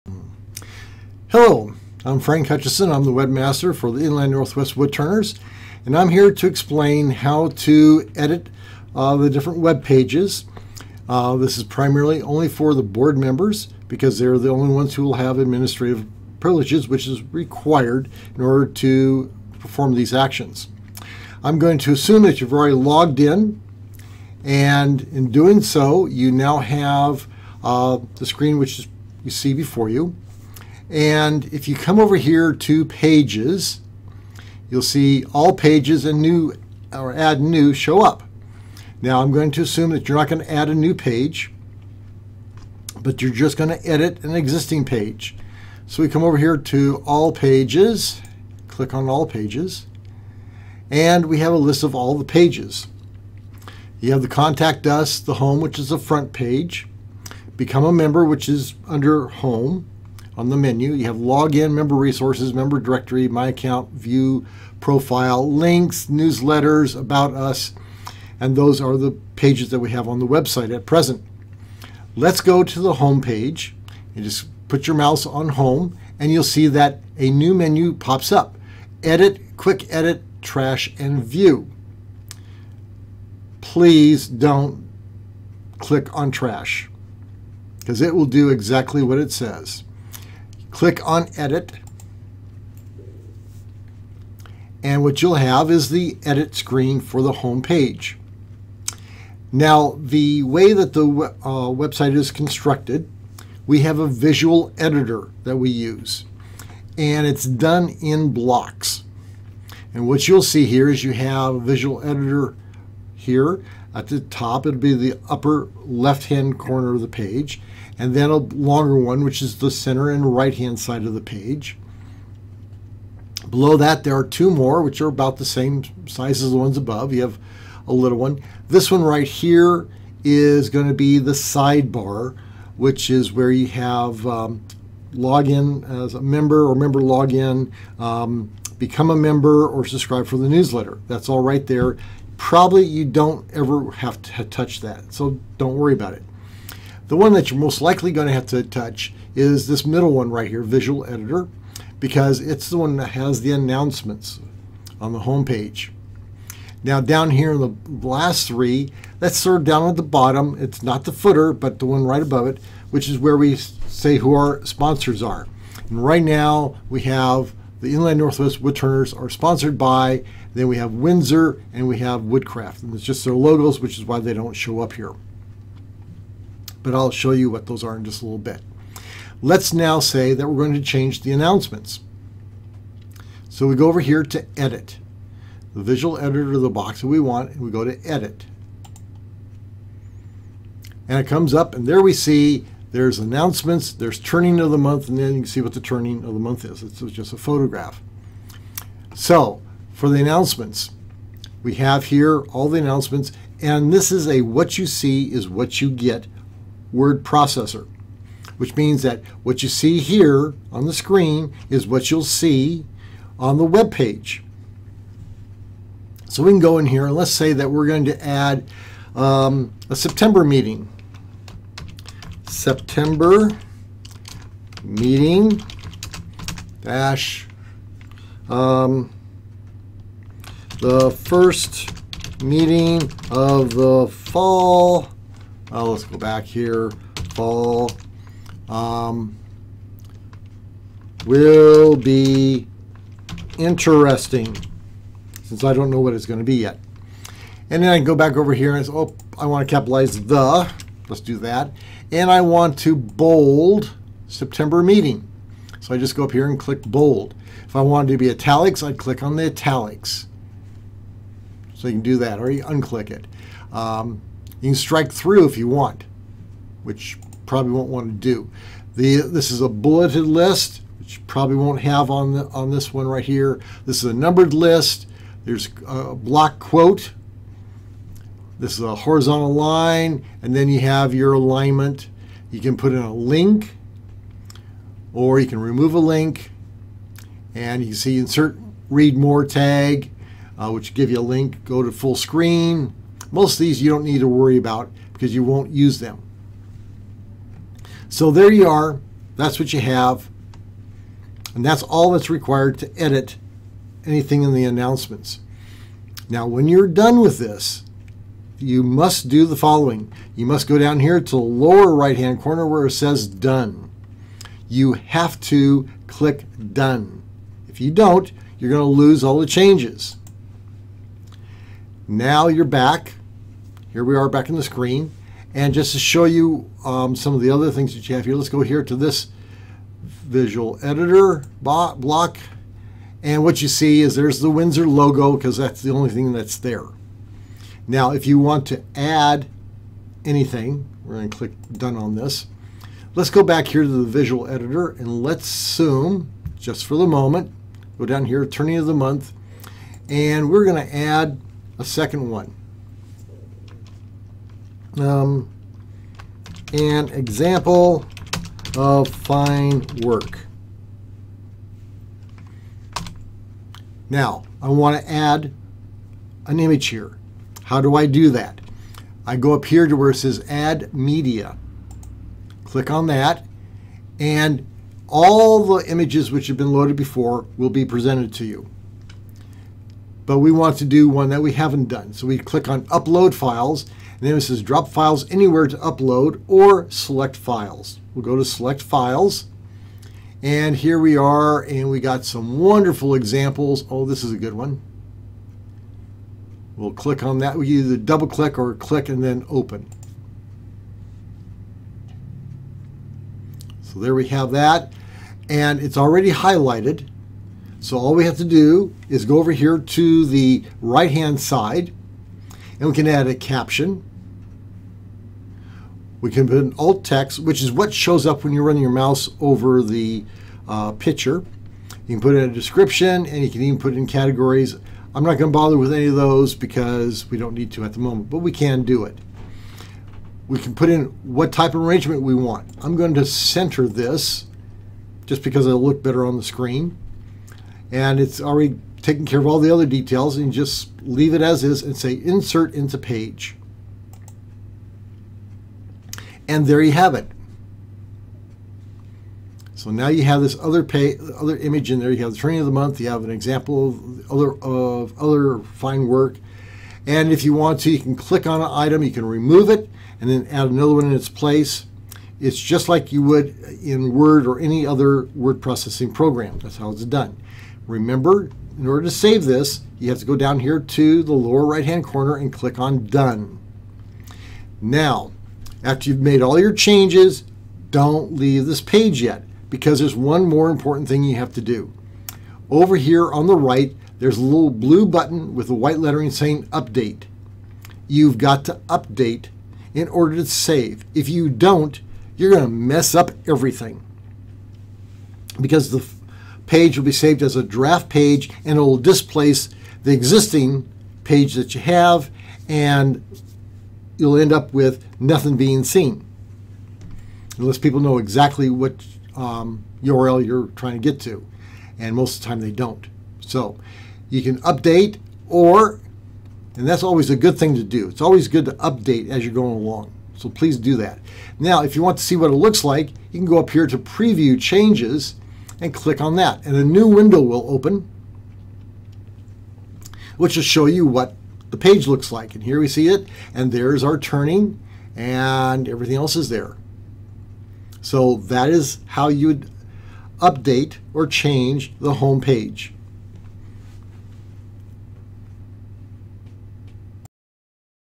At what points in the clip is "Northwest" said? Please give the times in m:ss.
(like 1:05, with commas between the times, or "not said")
0:04, 2:48.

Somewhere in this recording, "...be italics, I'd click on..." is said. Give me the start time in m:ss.
4:18.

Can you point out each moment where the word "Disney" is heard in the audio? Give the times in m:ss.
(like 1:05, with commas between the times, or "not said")
not said.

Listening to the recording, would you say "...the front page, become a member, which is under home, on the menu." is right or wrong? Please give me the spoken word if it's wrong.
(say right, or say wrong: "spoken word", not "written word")
right.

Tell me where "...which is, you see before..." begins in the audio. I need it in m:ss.
0:28.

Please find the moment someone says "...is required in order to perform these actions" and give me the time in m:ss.
0:17.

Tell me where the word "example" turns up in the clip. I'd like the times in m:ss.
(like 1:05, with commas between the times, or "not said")
5:57, 6:33, 7:33.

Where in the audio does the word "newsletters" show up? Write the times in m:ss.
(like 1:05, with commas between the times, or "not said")
1:06, 2:20.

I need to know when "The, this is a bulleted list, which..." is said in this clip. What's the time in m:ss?
4:28.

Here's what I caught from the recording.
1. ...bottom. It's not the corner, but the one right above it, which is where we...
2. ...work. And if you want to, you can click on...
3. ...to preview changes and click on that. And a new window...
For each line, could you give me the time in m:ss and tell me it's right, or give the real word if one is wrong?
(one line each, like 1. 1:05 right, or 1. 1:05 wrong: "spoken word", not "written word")
1. 2:40 wrong: "footer", not "corner"
2. 7:36 right
3. 8:43 right.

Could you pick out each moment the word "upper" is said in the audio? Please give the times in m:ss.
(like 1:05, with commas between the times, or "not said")
1:55.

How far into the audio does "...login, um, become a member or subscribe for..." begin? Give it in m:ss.
2:17.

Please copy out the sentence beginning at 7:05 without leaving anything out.
I'm not going to bother with any of those because we don't need to at the moment, but we can do it.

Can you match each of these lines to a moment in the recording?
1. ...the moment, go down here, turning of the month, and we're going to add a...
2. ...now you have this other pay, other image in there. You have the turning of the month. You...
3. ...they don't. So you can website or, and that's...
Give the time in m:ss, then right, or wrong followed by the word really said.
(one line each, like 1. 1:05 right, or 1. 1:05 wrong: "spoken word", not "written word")
1. 5:46 right
2. 7:29 wrong: "training", not "turning"
3. 8:32 wrong: "update", not "website".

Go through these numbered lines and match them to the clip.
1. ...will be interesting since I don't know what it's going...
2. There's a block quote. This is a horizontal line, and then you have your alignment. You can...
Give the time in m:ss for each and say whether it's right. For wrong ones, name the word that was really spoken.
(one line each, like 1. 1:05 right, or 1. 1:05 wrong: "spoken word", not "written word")
1. 4:01 right
2. 4:35 right.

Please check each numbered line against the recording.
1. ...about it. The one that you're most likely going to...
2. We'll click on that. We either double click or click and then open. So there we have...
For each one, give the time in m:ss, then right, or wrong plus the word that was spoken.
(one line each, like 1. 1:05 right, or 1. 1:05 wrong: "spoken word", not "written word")
1. 2:25 right
2. 6:36 right.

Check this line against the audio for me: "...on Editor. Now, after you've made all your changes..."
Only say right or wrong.
wrong.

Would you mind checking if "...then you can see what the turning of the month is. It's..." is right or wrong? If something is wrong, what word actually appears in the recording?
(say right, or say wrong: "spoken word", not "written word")
right.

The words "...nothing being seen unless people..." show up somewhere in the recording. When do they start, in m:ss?
8:25.